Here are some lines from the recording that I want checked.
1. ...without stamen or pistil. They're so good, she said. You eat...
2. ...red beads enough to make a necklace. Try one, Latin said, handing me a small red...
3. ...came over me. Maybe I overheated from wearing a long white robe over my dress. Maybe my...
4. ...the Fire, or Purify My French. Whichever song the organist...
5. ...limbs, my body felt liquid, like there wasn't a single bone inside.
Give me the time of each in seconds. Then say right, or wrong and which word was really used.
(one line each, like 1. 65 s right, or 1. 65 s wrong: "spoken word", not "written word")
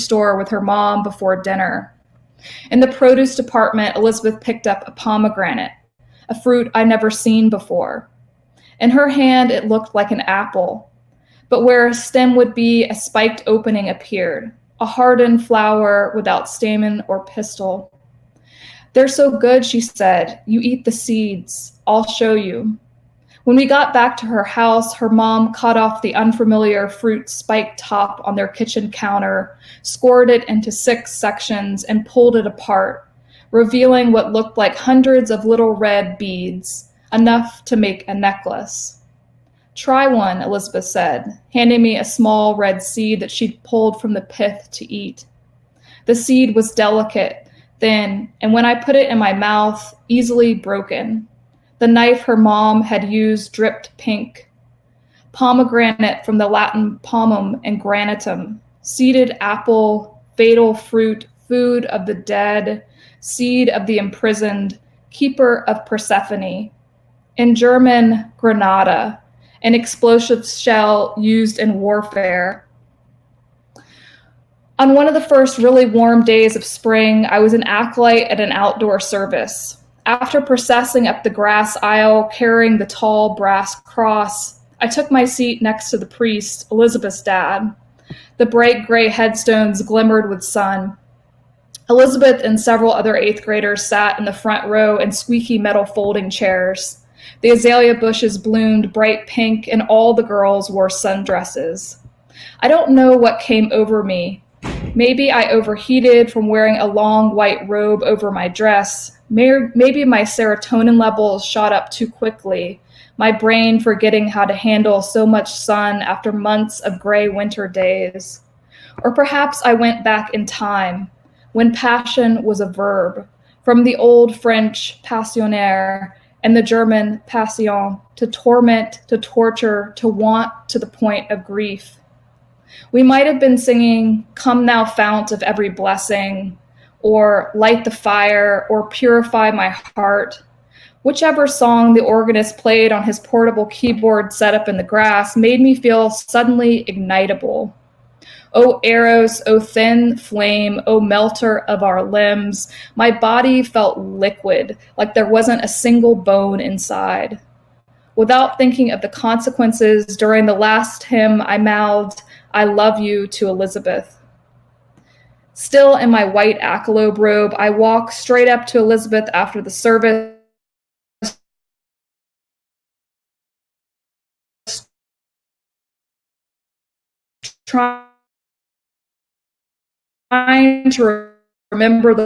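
1. 16 s right
2. 35 s wrong: "Elizabeth", not "Latin"
3. 103 s right
4. 137 s wrong: "Heart", not "French"
5. 152 s right.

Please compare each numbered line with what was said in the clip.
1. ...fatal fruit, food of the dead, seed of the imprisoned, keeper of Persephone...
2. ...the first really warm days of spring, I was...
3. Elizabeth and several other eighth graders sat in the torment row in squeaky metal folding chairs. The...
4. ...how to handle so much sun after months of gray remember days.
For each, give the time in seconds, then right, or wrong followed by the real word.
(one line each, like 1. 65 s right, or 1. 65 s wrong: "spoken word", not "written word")
1. 60 s right
2. 75 s right
3. 91 s wrong: "front", not "torment"
4. 114 s wrong: "winter", not "remember".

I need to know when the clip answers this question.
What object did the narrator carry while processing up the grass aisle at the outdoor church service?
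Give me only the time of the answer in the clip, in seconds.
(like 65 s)
82 s.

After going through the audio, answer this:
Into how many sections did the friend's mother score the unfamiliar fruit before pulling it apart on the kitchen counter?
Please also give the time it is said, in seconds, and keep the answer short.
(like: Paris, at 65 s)
6, at 30 s.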